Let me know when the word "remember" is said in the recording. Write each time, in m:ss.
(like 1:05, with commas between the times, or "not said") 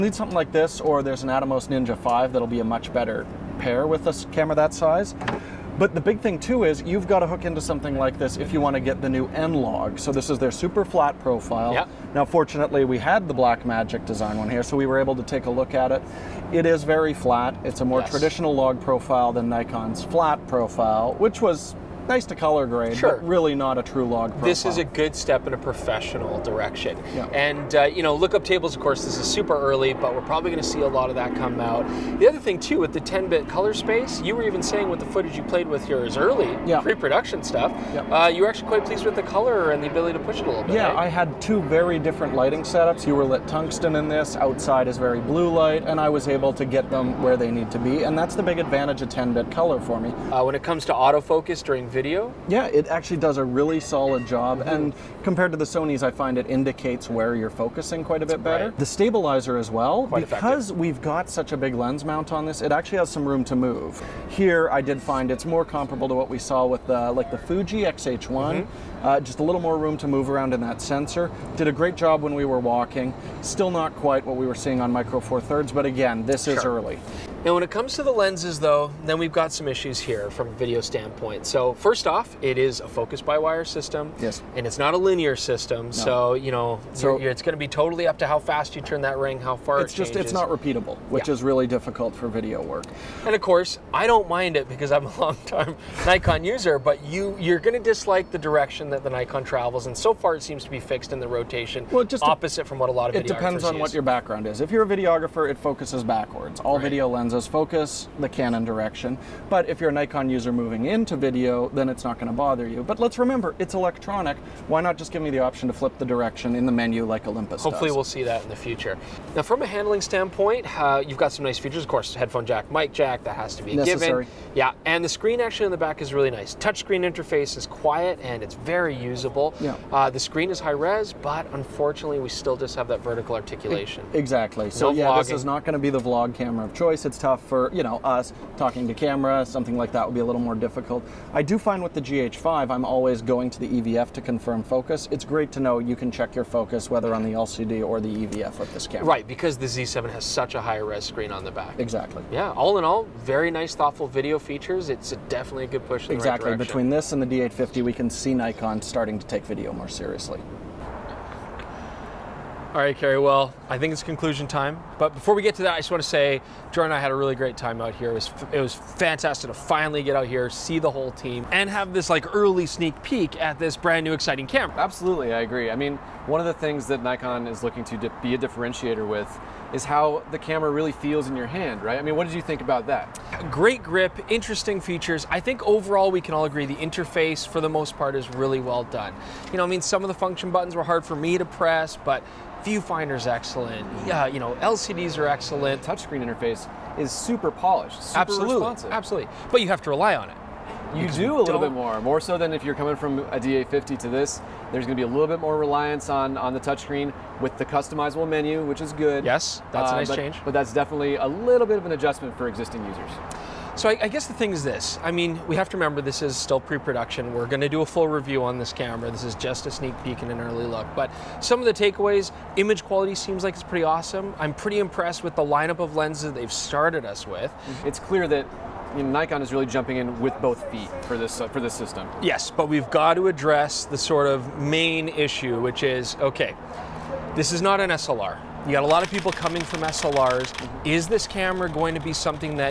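1:53, 3:35.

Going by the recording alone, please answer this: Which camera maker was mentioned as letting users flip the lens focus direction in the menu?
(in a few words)
Olympus.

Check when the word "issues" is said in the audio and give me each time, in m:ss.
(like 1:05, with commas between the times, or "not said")
1:19, 3:55.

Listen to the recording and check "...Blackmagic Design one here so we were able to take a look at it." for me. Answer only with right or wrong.
right.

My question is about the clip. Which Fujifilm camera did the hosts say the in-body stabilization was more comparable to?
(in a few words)
Fuji X-H1.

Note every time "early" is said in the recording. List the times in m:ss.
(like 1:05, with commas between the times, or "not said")
0:29, 0:36, 1:16, 2:52, 3:40.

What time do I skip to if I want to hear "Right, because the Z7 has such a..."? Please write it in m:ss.
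2:29.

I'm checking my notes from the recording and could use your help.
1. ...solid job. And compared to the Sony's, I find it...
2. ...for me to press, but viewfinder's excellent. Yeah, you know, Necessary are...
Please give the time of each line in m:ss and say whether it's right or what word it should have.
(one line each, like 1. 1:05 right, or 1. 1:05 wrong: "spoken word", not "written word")
1. 0:53 right
2. 3:11 wrong: "LCDs", not "Necessary".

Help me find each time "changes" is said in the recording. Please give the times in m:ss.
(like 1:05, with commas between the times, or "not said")
1:30, 3:30.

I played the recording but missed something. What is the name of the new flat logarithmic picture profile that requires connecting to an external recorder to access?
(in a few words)
N-Log.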